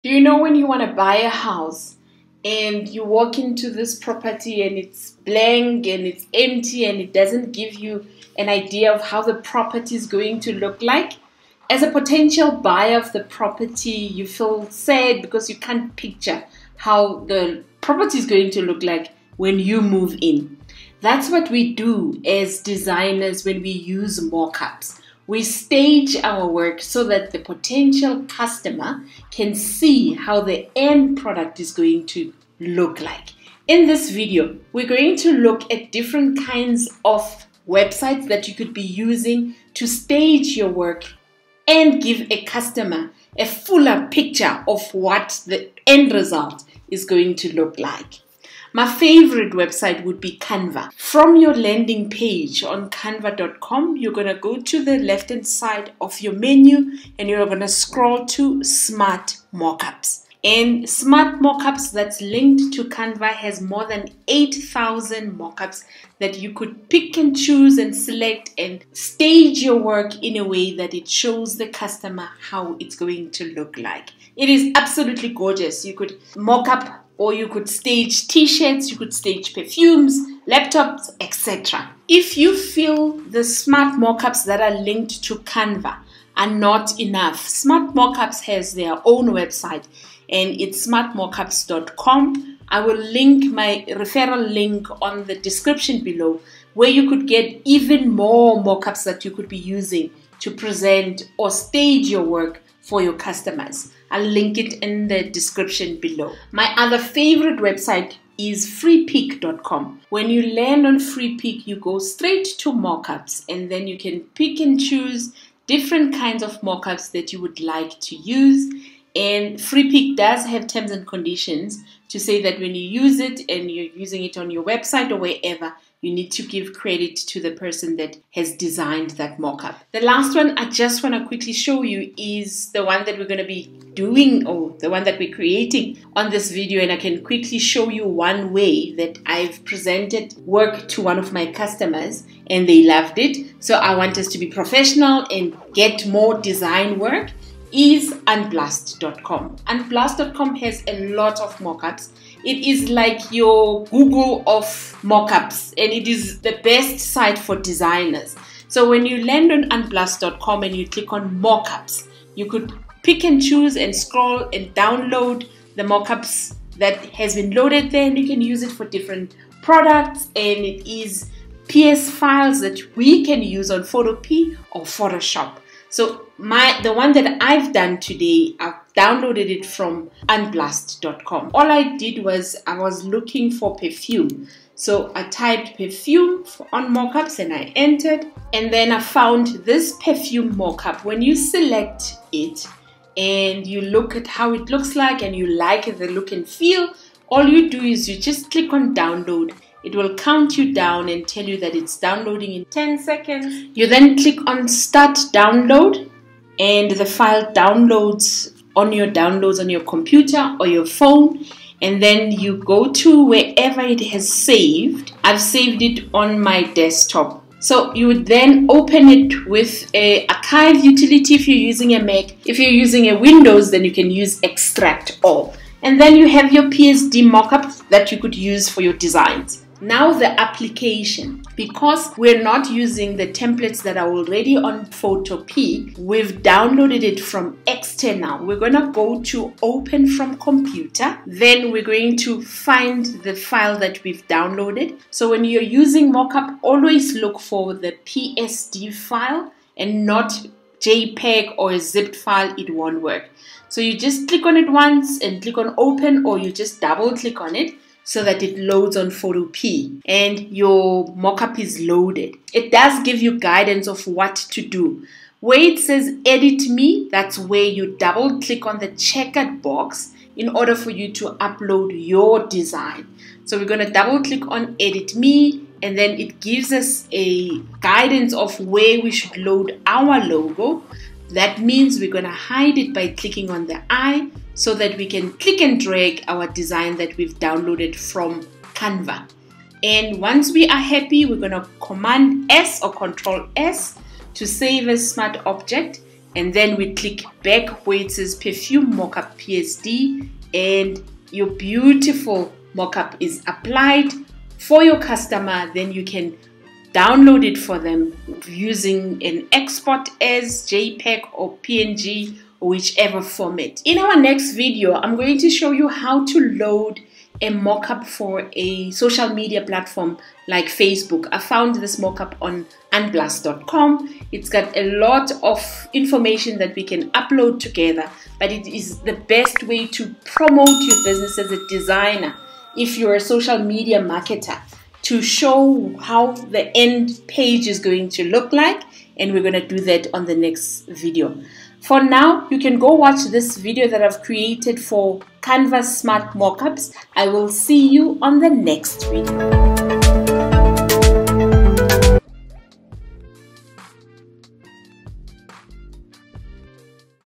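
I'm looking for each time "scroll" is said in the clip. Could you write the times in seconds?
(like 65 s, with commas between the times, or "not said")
57 s, 163 s.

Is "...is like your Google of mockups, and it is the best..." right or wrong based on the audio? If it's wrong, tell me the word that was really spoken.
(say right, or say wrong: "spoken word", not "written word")
right.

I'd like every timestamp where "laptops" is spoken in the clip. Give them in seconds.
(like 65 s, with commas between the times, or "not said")
80 s.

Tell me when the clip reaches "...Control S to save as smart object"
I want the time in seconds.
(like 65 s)
292 s.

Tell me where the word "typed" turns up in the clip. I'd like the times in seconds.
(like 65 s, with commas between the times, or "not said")
185 s.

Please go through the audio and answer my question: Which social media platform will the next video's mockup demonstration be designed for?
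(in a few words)
Facebook.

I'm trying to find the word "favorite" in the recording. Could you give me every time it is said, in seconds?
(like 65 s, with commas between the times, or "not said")
48 s, 106 s.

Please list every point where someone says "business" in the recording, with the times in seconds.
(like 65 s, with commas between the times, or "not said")
331 s.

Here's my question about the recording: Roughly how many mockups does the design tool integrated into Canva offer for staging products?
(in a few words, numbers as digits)
8,000.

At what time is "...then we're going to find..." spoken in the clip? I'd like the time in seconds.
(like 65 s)
241 s.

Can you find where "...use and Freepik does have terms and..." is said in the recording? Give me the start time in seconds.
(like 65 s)
118 s.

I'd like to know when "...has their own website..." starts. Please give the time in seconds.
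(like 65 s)
88 s.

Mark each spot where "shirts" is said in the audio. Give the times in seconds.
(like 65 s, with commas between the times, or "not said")
78 s.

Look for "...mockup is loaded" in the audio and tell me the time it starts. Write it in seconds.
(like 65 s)
261 s.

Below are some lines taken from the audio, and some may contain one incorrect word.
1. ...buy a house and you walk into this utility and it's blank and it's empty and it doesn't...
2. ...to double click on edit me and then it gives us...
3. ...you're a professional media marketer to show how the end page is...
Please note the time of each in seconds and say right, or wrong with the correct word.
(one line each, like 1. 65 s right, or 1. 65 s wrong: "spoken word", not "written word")
1. 0 s wrong: "property", not "utility"
2. 273 s right
3. 332 s wrong: "social", not "professional".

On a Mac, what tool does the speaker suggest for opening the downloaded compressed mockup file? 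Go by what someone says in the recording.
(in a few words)
Archive Utility.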